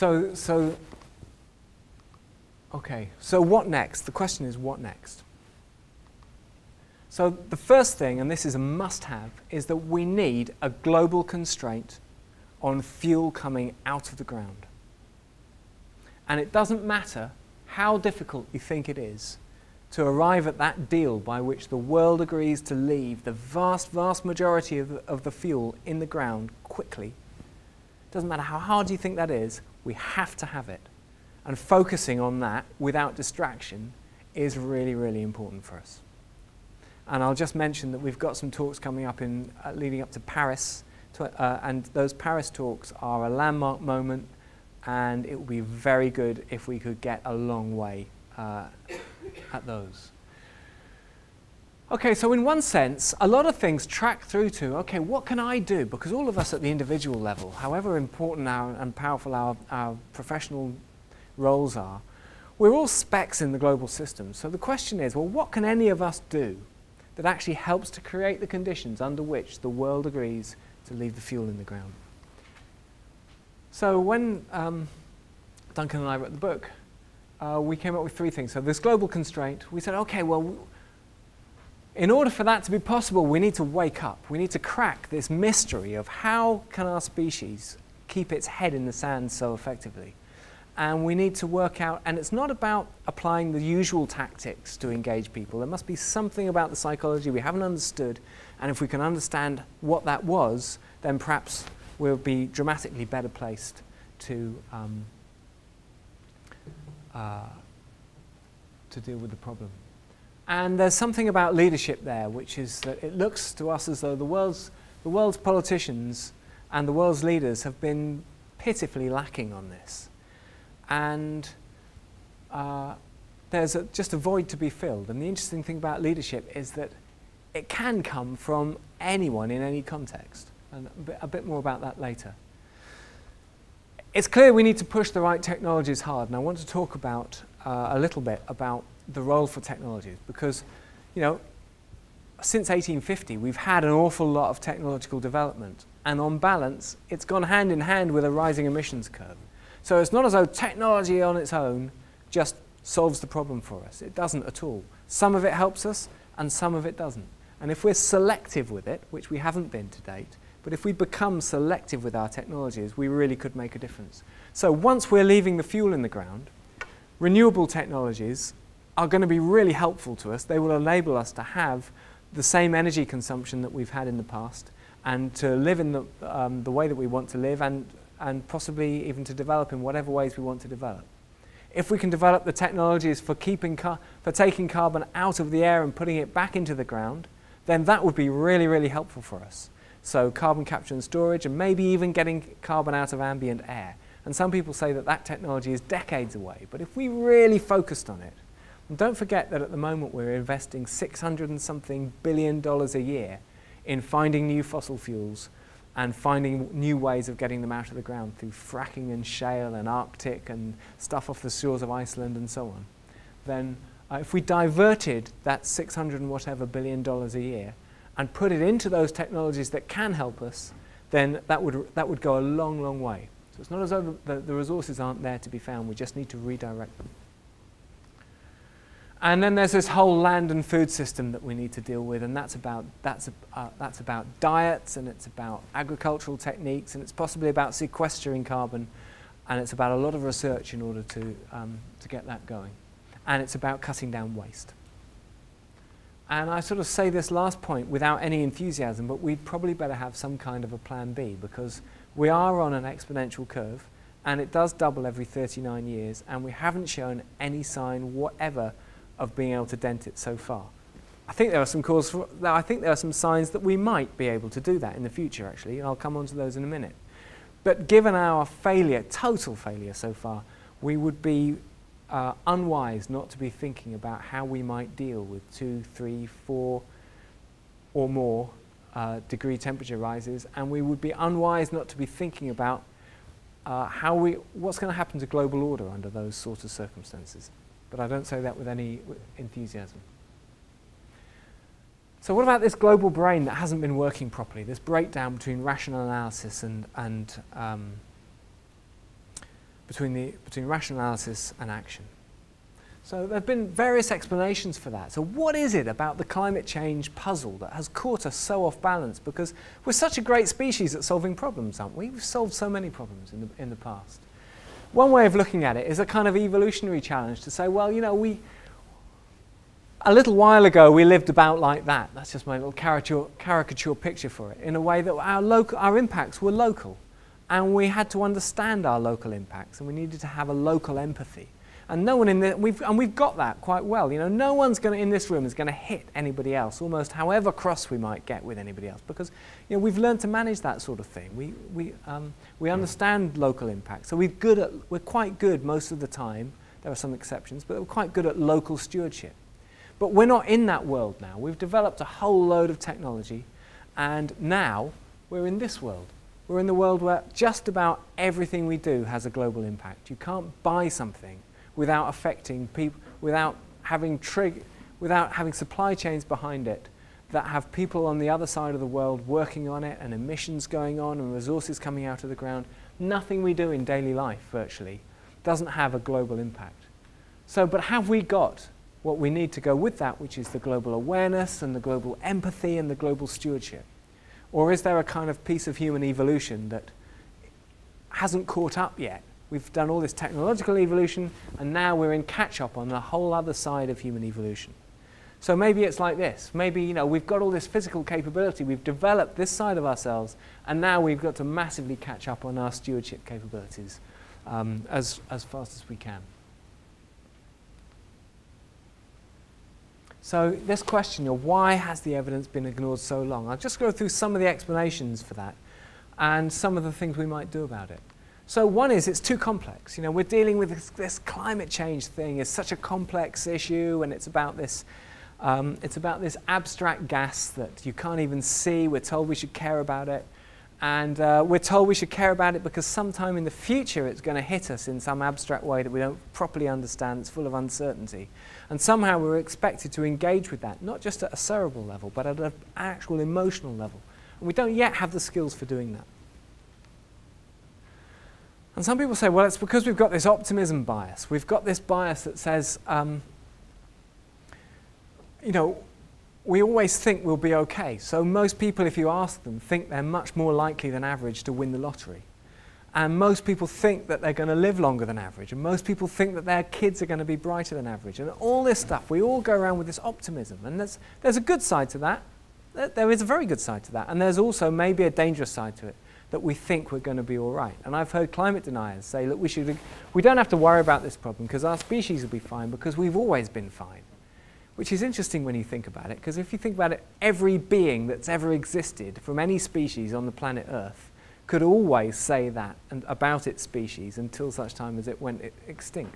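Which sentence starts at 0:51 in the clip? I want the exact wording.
Okay, so in one sense, a lot of things track through to, okay, what can I do?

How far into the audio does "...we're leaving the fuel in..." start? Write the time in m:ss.
2:45.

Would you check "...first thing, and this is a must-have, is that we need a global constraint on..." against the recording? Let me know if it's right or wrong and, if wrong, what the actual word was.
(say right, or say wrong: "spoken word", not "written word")
right.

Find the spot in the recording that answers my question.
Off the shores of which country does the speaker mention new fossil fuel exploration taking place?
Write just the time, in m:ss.
3:31.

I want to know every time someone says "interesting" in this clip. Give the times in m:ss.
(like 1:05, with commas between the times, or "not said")
2:05, 8:05.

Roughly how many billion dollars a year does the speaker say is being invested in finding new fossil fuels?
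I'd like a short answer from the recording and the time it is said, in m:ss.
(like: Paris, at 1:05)
600 billion, at 3:20.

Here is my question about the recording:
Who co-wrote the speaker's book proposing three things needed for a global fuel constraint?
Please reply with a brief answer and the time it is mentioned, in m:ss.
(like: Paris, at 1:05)
Duncan, at 1:15.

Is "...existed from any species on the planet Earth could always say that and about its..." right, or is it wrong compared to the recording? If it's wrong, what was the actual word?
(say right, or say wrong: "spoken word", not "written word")
right.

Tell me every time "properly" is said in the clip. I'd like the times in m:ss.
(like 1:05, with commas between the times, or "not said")
4:54, 7:16.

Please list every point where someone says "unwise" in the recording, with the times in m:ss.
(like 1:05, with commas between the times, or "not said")
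4:32, 4:41.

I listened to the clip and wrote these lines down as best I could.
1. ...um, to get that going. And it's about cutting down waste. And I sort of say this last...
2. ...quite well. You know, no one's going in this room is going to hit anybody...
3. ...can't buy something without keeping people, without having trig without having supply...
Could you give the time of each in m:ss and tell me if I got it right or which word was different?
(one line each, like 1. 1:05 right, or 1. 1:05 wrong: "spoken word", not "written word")
1. 4:01 right
2. 5:33 right
3. 6:00 wrong: "affecting", not "keeping".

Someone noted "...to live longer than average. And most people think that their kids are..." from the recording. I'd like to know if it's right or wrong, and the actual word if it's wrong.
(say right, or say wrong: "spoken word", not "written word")
right.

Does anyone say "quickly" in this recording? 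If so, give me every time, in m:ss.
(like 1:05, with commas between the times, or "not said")
0:26.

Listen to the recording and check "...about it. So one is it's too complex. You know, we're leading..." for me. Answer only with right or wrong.
wrong.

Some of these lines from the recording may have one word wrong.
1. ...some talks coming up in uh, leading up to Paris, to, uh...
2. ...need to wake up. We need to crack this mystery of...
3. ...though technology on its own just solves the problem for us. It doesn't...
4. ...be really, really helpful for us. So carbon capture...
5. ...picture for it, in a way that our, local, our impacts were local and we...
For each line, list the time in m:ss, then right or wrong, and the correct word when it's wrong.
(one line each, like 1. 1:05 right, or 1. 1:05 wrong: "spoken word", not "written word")
1. 0:38 right
2. 1:23 right
3. 2:30 right
4. 3:08 right
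5. 5:23 right.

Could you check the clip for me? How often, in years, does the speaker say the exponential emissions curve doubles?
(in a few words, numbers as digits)
39.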